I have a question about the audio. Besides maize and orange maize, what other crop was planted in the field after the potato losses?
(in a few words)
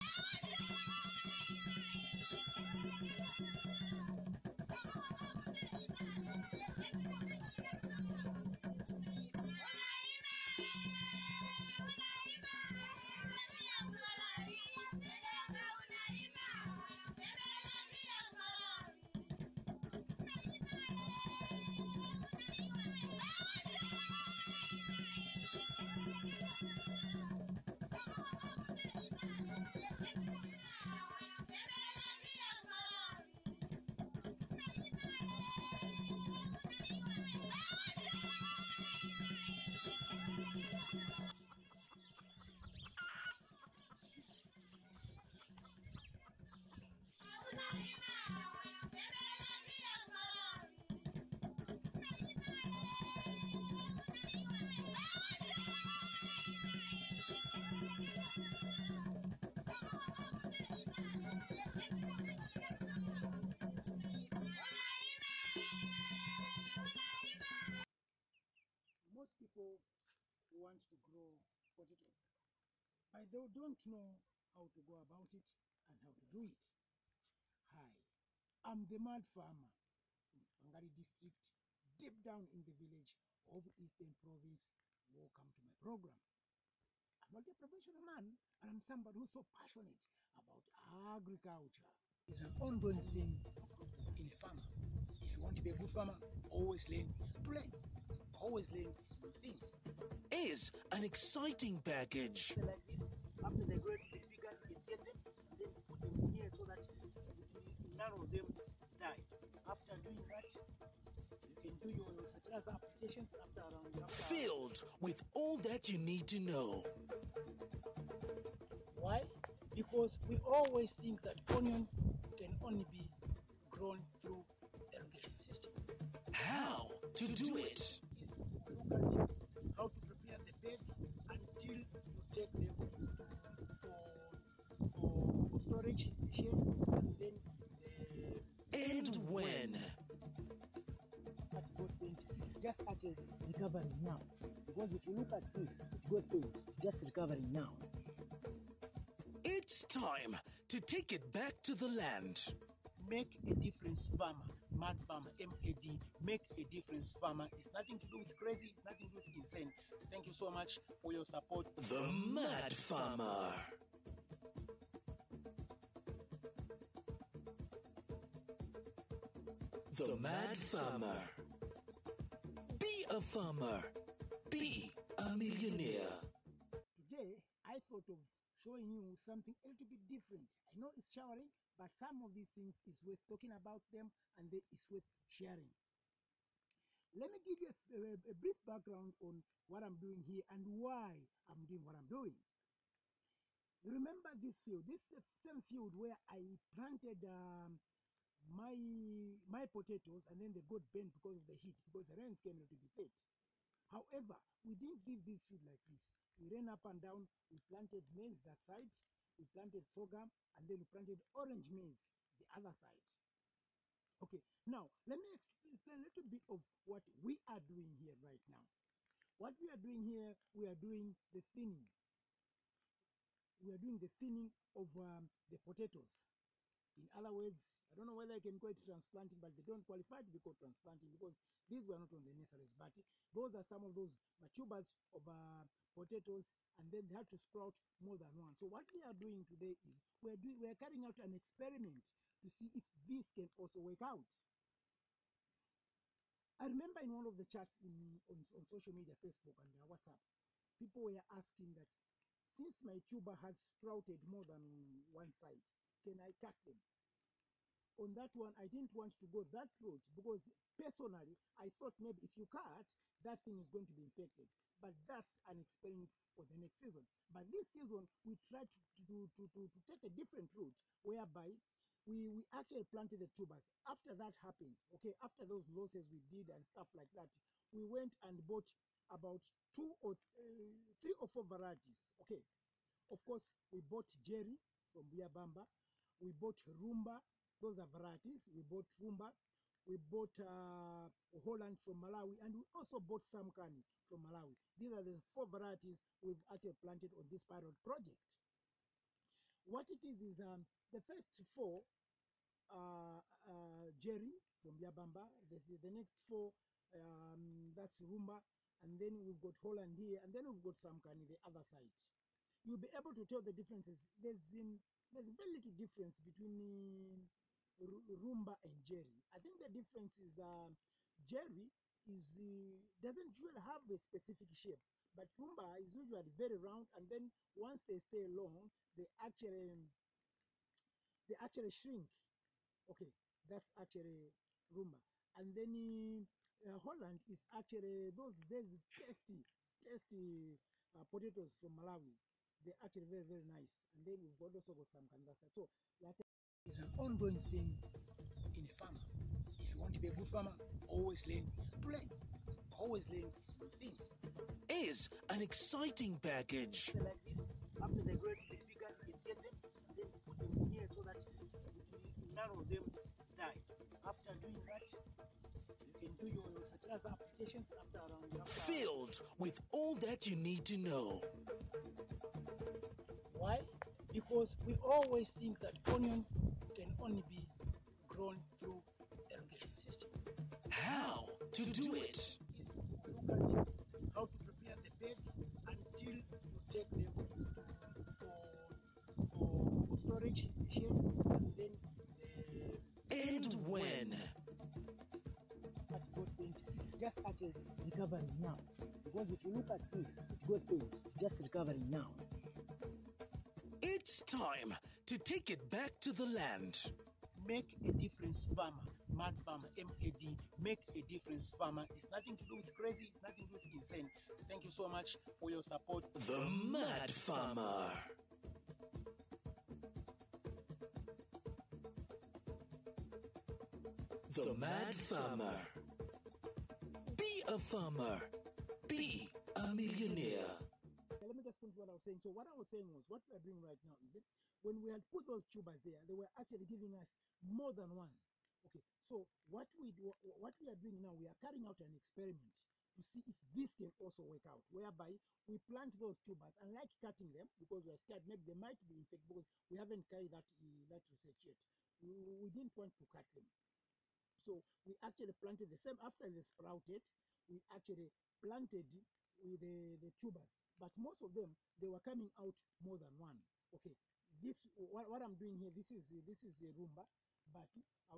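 Sorghum.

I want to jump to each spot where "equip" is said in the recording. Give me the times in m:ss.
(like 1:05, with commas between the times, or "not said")
not said.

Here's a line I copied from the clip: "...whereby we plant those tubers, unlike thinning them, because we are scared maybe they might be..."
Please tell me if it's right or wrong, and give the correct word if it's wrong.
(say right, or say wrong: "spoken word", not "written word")
wrong: "cutting", not "thinning".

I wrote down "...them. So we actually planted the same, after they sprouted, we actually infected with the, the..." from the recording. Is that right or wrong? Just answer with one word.
wrong.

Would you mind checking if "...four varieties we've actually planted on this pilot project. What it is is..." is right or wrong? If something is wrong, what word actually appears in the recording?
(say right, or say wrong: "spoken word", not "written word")
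right.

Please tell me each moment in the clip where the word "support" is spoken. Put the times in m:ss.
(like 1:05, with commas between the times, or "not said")
2:41, 6:55.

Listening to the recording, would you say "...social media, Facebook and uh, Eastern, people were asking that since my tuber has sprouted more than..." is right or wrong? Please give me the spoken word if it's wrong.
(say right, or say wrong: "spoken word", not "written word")
wrong: "WhatsApp", not "Eastern".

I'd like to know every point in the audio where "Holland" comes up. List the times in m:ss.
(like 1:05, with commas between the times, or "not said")
4:51, 5:09, 5:36.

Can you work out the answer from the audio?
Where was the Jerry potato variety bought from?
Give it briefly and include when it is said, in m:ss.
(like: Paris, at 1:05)
Buyabamba, at 4:45.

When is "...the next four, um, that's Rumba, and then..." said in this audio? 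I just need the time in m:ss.
5:05.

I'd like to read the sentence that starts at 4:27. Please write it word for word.
But this season, we tried to, to, to, to, to take a different route whereby we, we actually planted the tubers.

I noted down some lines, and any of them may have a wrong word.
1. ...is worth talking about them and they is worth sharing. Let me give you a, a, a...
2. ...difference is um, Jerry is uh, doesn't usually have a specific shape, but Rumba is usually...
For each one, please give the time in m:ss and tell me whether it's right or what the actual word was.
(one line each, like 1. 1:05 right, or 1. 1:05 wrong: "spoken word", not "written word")
1. 3:02 right
2. 5:19 right.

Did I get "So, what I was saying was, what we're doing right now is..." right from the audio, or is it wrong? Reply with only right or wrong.
right.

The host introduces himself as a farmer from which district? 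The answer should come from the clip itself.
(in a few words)
Angari.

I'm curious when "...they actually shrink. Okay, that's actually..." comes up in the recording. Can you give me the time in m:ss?
5:31.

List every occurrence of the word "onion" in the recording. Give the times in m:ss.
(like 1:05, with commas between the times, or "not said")
2:01, 6:15.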